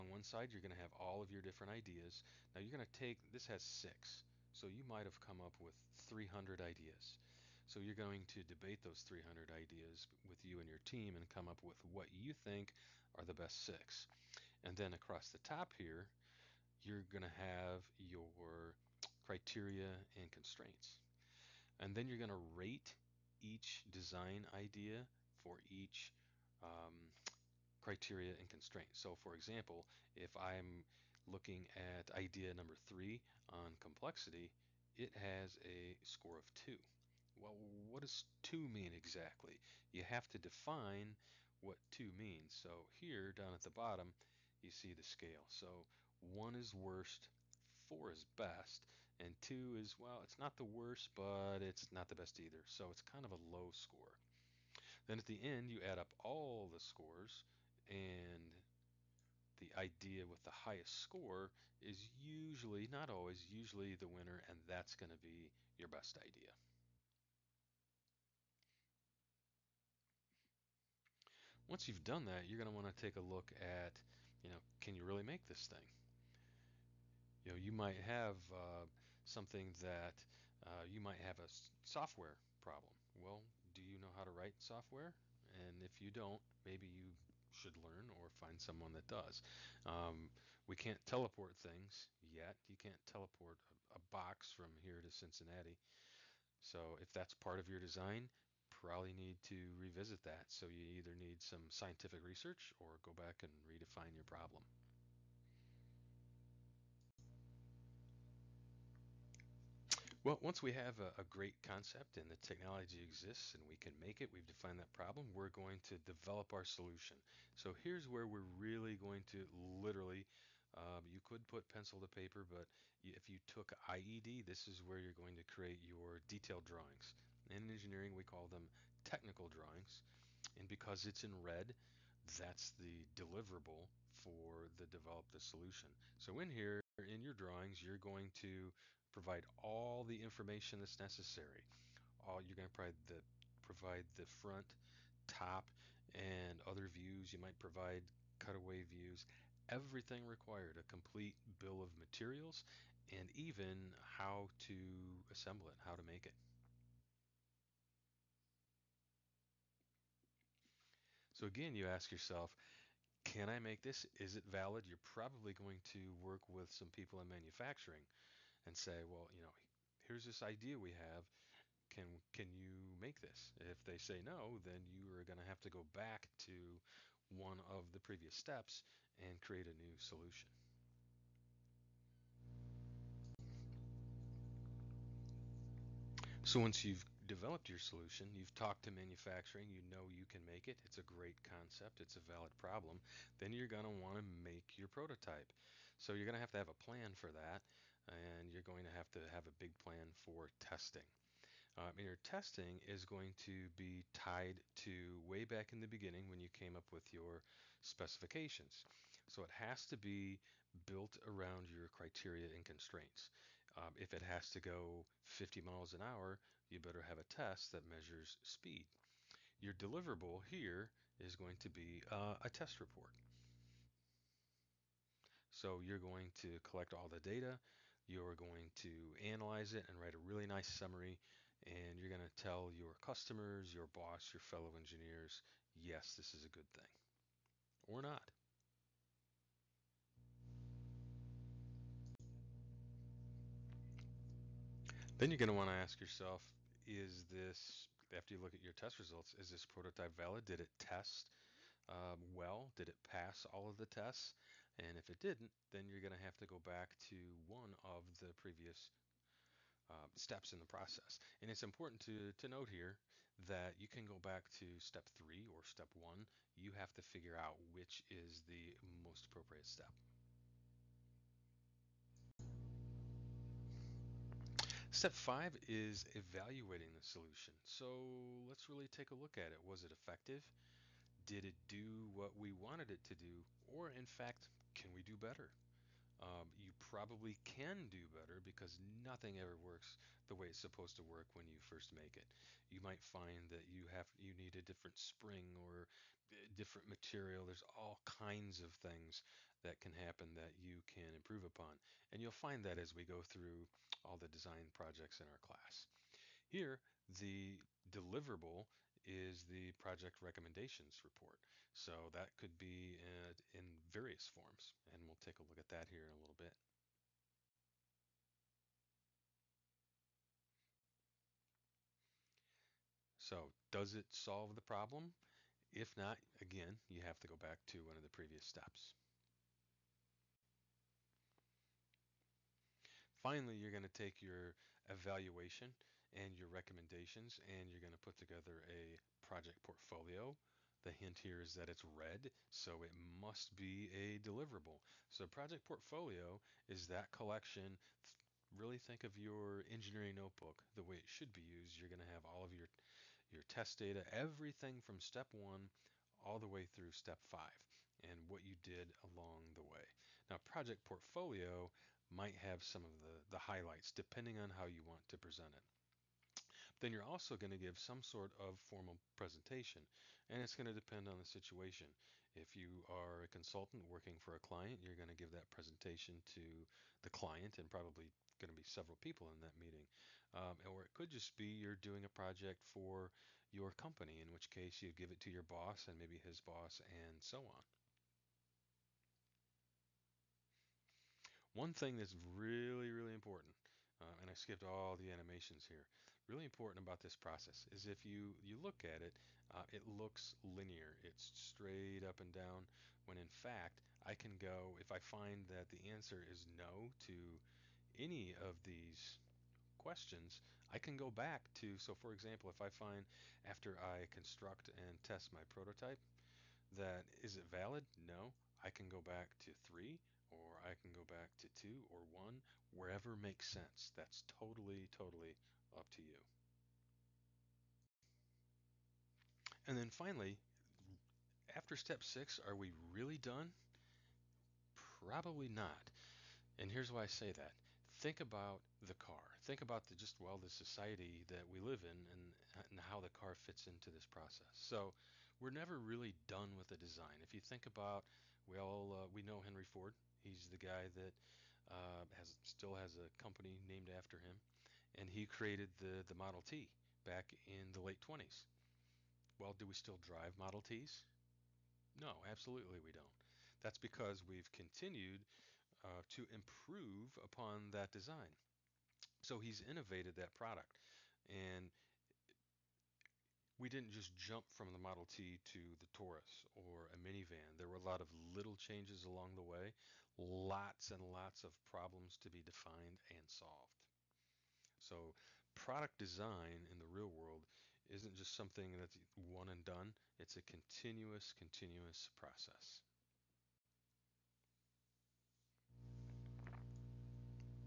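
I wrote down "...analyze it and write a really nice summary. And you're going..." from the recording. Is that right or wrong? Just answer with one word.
right.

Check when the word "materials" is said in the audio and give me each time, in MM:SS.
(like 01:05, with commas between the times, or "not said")
02:31, 04:56.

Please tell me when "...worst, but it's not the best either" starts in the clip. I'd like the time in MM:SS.
00:50.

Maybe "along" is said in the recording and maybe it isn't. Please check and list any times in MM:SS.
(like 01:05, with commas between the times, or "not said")
05:59, 07:59.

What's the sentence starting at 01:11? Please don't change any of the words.
Once you've done that, you're going to want to take a look at, you know, can you really make this thing?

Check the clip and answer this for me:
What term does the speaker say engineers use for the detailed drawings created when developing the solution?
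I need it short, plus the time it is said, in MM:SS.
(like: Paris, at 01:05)
technical drawings, at 02:09.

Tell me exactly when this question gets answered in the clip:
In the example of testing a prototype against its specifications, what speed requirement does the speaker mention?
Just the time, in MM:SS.
03:35.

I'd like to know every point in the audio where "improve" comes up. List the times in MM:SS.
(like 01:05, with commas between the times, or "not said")
05:01, 07:46.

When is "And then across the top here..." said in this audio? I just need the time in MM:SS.
00:14.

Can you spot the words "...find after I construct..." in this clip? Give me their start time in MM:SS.
06:52.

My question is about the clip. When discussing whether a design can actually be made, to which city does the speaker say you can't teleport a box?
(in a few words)
Cincinnati.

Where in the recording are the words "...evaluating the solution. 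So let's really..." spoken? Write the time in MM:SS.
04:36.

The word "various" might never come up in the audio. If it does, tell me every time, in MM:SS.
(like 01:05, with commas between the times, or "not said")
05:13.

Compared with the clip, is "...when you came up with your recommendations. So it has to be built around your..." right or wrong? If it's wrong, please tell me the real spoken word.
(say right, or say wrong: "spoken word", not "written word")
wrong: "specifications", not "recommendations".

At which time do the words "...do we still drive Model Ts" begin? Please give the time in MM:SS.
07:39.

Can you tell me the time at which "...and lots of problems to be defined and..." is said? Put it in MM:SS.
08:00.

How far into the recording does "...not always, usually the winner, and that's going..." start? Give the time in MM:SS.
01:02.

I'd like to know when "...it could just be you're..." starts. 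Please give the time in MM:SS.
06:20.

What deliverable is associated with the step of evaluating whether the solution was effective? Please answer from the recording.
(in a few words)
project recommendations report.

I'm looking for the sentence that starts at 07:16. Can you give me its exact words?
And here's why I say that think about the car.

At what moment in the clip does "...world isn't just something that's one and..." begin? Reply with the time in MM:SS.
08:07.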